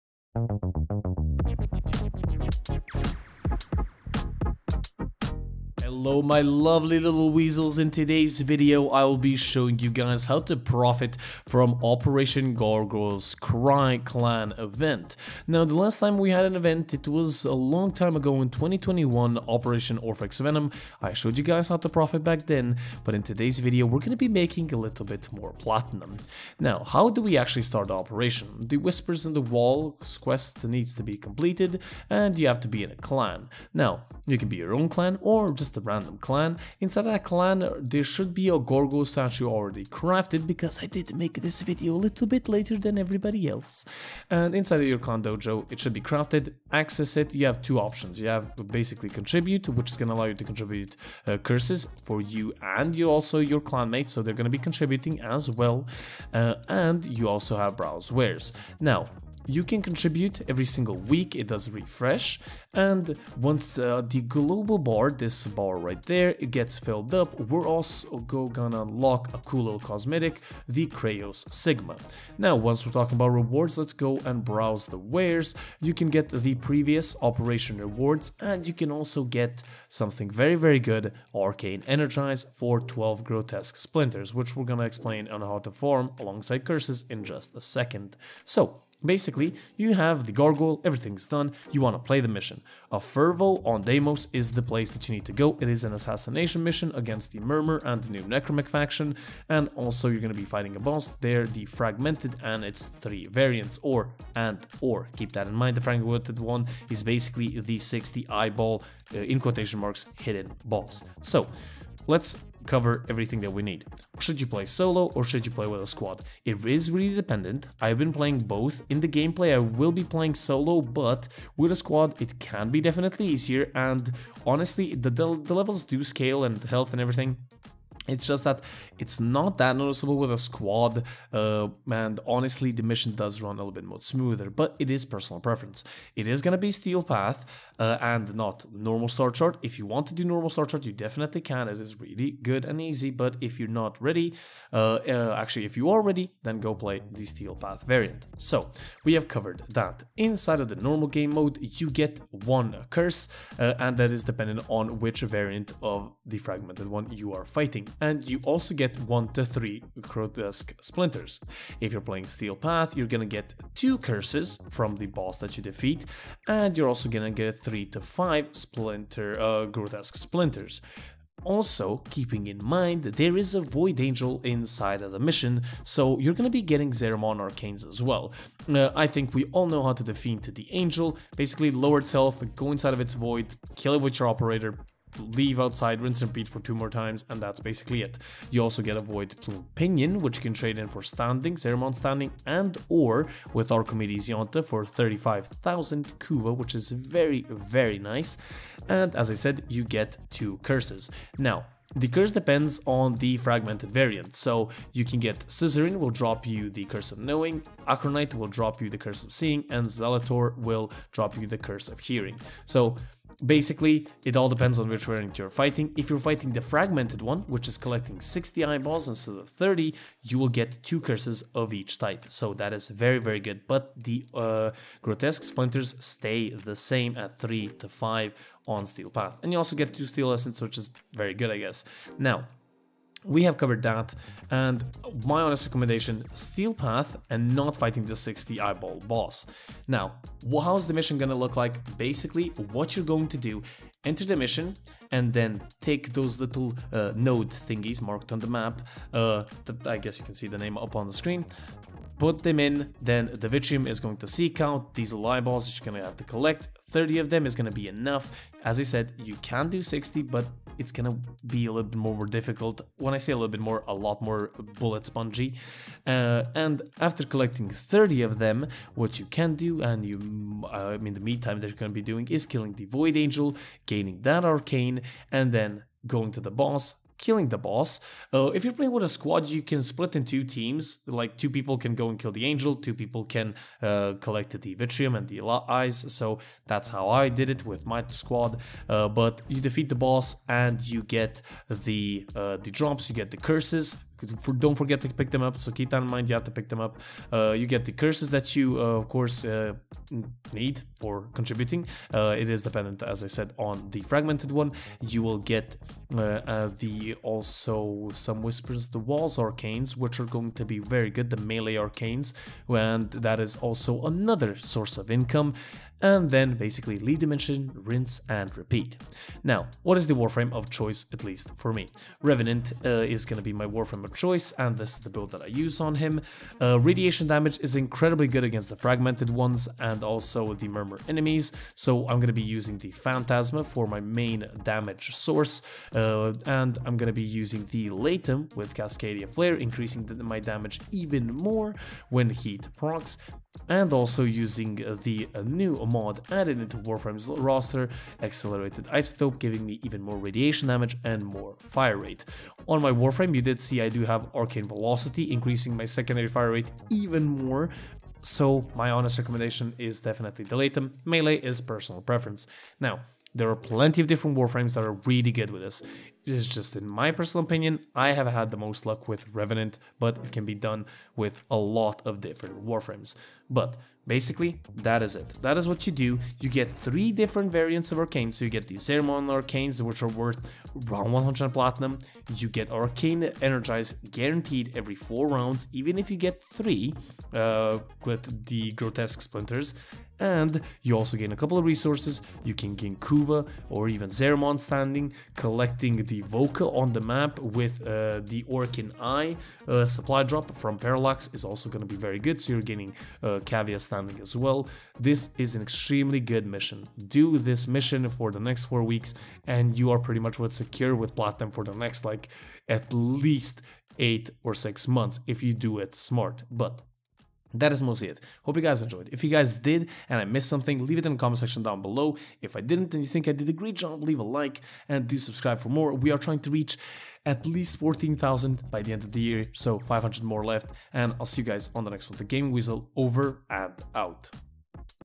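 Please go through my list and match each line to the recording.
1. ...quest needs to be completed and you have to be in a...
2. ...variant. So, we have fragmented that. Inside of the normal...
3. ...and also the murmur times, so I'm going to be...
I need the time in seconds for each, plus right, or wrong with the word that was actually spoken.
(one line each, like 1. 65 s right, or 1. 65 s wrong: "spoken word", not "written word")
1. 30 s right
2. 147 s wrong: "covered", not "fragmented"
3. 329 s wrong: "enemies", not "times".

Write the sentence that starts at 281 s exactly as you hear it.
Like two people can go and kill the angel, two people can uh, collect the vitreum and the eyes.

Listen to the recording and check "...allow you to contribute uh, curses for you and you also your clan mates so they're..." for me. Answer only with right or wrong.
right.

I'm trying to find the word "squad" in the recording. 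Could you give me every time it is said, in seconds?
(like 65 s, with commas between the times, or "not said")
115 s, 121 s, 130 s, 279 s, 288 s.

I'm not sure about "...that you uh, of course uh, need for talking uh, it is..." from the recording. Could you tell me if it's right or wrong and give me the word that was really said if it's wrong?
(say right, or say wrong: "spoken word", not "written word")
wrong: "contributing", not "talking".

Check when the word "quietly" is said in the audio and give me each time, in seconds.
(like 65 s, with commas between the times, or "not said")
not said.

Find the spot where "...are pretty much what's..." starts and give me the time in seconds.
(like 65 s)
409 s.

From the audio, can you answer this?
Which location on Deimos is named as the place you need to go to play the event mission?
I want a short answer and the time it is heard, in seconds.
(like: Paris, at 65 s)
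Effervo, at 92 s.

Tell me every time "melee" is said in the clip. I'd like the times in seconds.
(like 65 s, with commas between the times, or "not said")
311 s, 361 s.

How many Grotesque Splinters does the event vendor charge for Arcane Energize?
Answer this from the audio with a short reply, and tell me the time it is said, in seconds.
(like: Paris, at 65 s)
12, at 82 s.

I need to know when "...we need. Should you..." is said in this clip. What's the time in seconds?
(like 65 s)
113 s.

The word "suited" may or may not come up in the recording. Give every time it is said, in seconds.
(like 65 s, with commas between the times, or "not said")
not said.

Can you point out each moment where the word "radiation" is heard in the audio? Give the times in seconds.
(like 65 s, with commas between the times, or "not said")
326 s, 350 s.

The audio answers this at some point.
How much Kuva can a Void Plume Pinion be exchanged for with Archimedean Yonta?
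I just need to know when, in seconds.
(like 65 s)
194 s.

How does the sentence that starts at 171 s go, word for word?
Also, keeping in mind there is a Void Angel inside of the mission, so you're gonna be getting Zariman Arcanes as well.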